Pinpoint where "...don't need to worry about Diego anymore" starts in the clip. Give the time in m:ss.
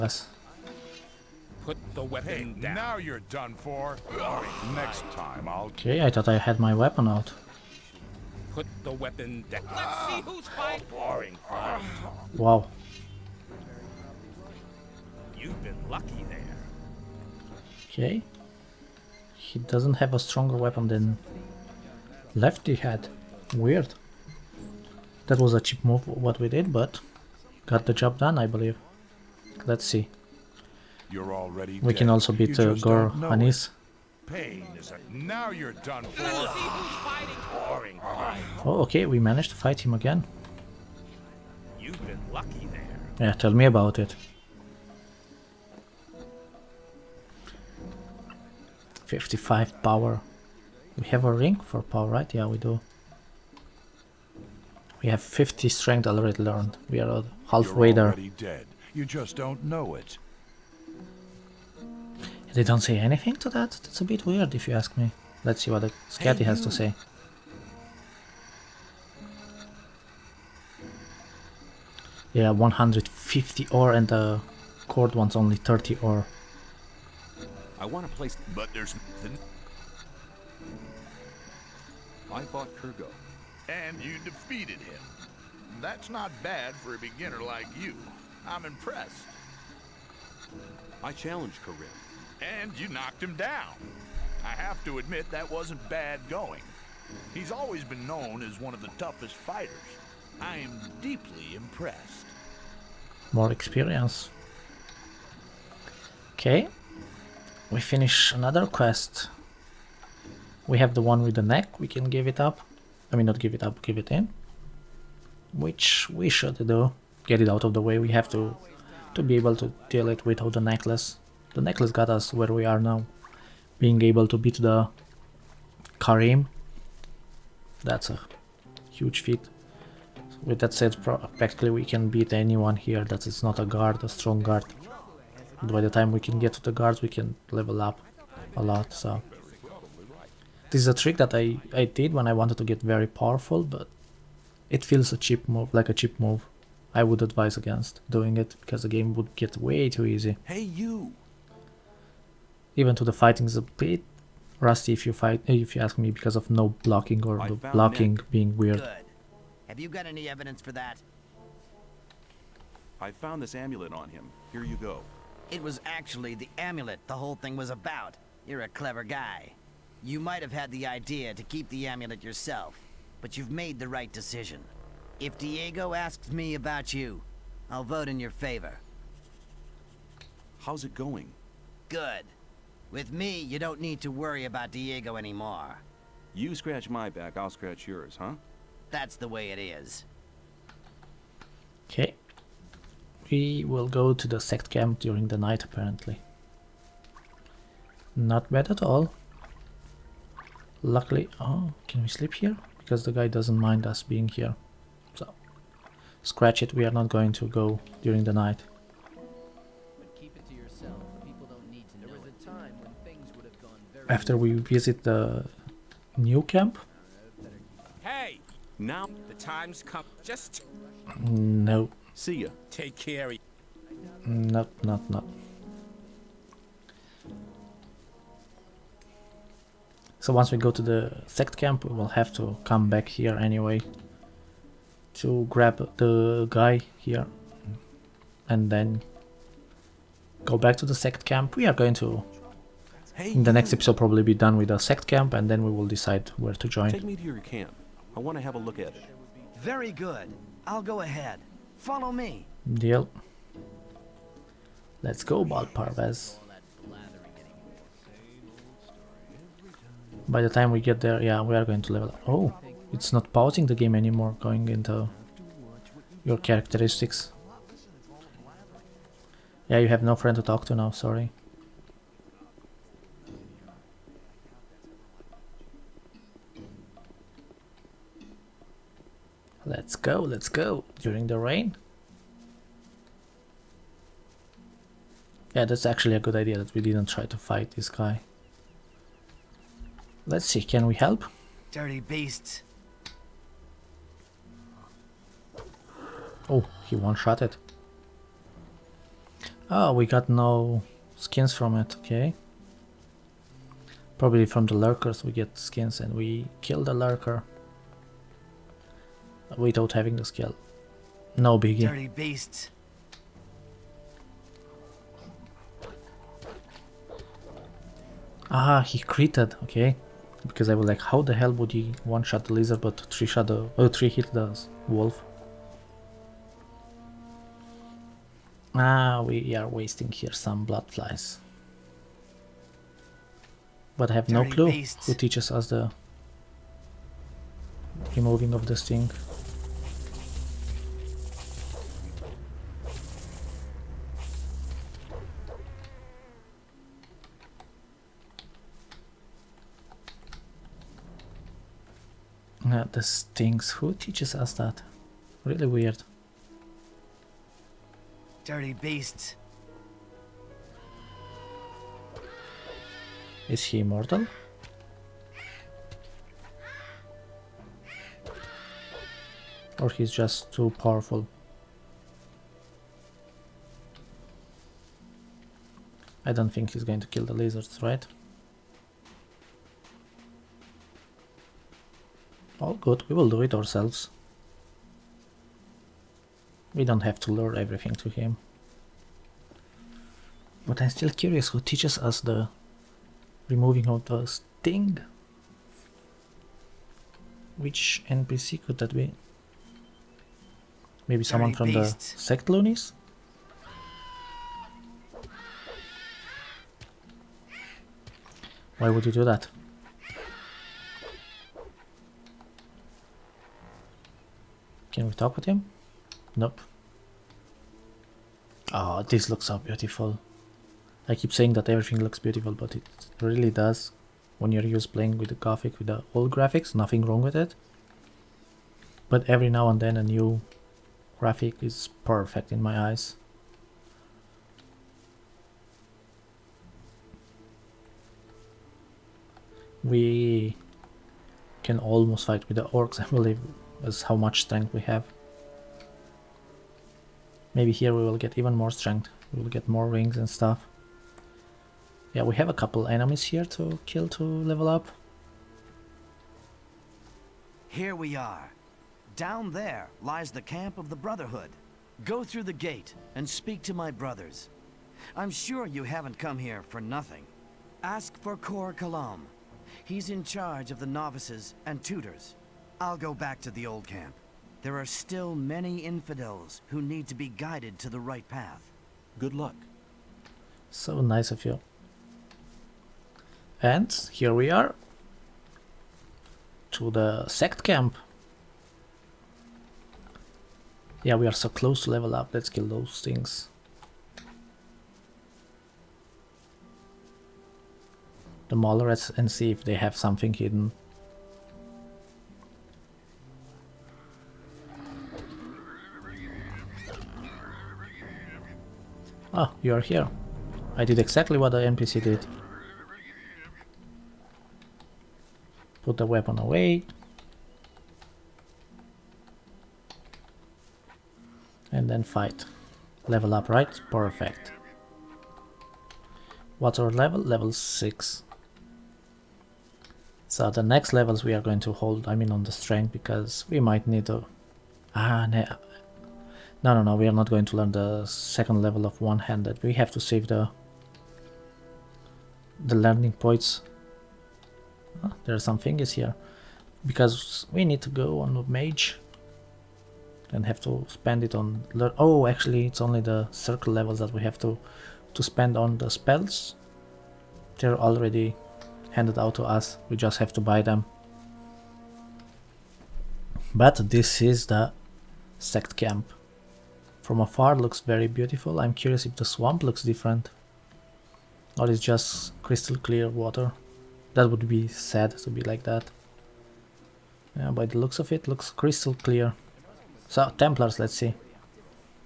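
3:03.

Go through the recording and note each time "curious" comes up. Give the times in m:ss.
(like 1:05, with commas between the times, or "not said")
6:31, 9:28.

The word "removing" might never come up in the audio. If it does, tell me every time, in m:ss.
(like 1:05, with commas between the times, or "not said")
5:38, 6:33.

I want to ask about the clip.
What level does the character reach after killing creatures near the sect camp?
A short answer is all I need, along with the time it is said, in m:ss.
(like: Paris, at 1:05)
Level 6, at 8:47.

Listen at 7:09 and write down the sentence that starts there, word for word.
But every now and then a new graphic is perfect in my eyes.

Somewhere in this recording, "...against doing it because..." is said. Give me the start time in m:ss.
2:27.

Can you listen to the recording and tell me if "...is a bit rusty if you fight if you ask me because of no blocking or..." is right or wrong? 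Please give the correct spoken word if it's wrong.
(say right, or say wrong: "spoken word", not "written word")
right.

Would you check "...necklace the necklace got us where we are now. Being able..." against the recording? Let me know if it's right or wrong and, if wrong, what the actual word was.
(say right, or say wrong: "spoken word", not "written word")
right.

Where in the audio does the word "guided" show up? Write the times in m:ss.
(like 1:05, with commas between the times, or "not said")
7:57.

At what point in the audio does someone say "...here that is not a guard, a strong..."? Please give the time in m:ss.
2:12.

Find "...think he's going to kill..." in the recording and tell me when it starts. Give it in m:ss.
6:16.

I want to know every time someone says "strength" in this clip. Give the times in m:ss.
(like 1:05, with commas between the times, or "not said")
0:55, 7:24, 7:28, 8:52.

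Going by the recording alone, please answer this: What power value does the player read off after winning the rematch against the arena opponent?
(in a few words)
55.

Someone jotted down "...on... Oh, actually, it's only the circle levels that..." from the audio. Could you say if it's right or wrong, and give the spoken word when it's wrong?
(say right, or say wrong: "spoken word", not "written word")
right.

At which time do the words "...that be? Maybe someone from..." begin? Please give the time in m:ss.
6:38.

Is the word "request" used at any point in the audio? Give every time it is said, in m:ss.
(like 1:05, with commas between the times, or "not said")
not said.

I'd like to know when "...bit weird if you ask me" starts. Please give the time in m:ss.
1:04.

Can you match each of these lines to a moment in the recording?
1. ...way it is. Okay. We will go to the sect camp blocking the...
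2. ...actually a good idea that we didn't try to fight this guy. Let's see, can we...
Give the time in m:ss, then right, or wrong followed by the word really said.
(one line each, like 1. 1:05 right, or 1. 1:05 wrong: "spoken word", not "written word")
1. 3:09 wrong: "during", not "blocking"
2. 4:45 right.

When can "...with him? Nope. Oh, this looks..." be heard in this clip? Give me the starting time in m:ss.
6:55.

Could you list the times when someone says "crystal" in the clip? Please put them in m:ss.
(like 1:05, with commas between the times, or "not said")
9:32, 9:38.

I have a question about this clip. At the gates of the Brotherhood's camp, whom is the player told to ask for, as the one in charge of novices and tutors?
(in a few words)
Cor Kalom.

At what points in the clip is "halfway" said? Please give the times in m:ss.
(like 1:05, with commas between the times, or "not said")
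0:57.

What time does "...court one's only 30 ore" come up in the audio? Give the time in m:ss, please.
1:14.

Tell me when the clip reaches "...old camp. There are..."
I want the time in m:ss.
7:53.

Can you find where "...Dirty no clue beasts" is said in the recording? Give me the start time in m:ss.
5:34.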